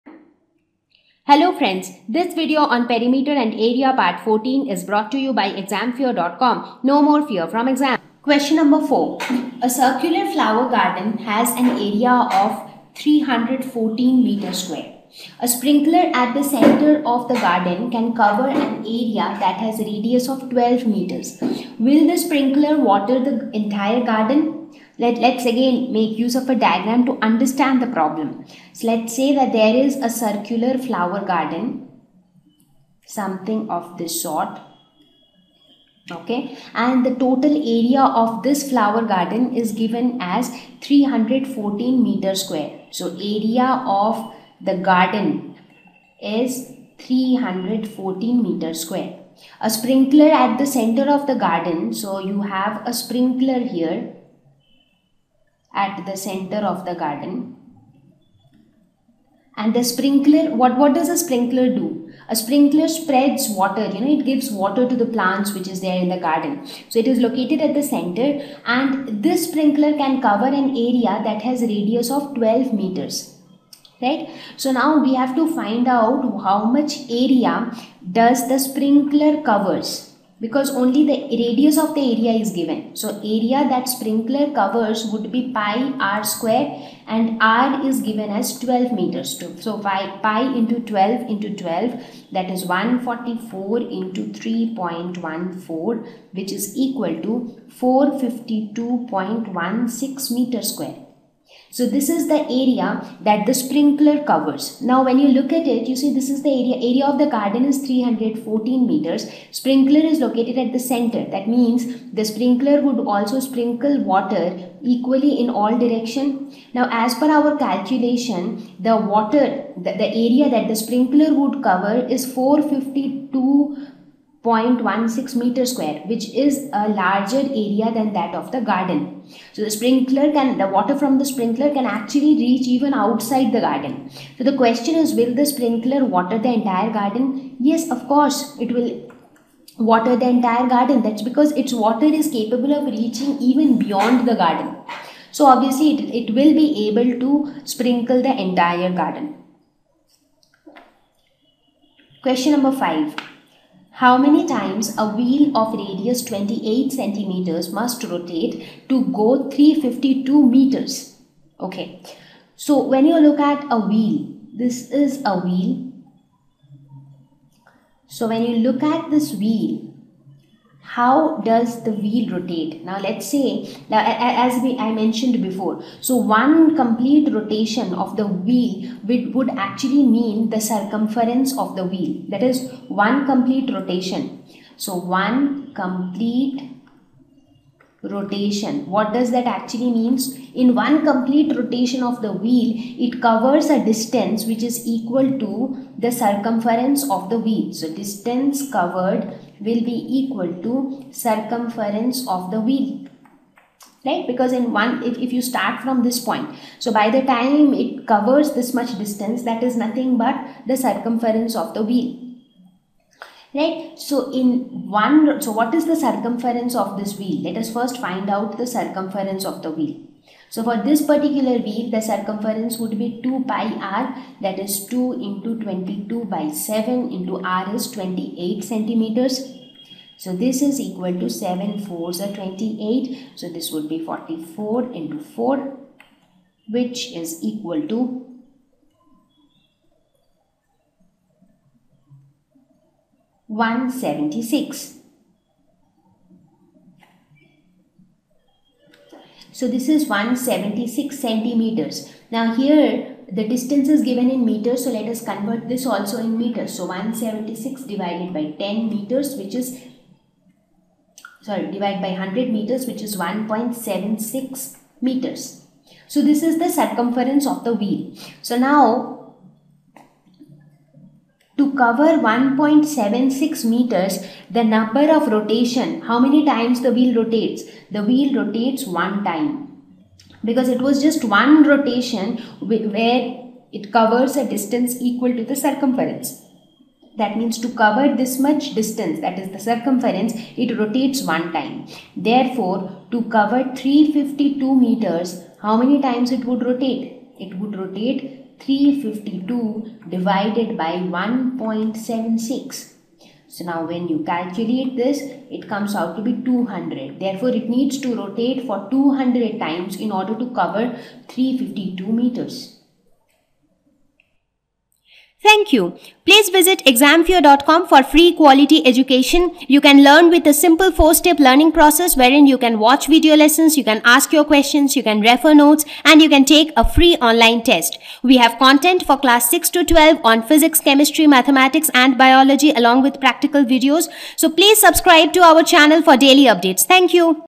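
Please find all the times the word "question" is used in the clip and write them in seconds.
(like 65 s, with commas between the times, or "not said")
8 s, 134 s, 152 s, 324 s.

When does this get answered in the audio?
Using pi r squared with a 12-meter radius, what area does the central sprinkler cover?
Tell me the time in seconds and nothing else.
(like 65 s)
97 s.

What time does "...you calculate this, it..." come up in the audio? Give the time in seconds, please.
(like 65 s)
304 s.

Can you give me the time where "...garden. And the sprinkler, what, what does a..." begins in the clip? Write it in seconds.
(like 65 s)
56 s.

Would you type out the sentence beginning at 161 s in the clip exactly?
Okay, so when you look at a wheel, this is a wheel.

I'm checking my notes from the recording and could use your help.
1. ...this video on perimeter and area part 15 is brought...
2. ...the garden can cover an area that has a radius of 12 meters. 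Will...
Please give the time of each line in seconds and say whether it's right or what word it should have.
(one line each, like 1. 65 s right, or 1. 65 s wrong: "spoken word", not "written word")
1. 2 s wrong: "14", not "15"
2. 17 s right.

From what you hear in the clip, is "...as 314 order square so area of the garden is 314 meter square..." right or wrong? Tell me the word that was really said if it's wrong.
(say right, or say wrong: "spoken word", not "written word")
wrong: "meter", not "order".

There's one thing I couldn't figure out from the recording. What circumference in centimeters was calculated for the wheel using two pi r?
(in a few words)
176 centimeters.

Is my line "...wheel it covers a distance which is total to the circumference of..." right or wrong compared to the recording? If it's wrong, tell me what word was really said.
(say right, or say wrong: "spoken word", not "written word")
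wrong: "equal", not "total".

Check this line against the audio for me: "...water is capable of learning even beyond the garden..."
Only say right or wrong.
wrong.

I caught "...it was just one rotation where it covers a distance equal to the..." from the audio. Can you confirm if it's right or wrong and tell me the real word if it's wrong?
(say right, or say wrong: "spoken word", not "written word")
right.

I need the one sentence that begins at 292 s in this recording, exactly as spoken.
Therefore, to cover 352 meters, how many times it would rotate?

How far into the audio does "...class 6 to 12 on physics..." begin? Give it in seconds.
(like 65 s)
329 s.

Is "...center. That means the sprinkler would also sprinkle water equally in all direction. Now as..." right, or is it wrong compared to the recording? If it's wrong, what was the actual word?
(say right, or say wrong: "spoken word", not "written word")
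right.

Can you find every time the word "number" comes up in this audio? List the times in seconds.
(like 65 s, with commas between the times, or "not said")
8 s, 152 s, 274 s.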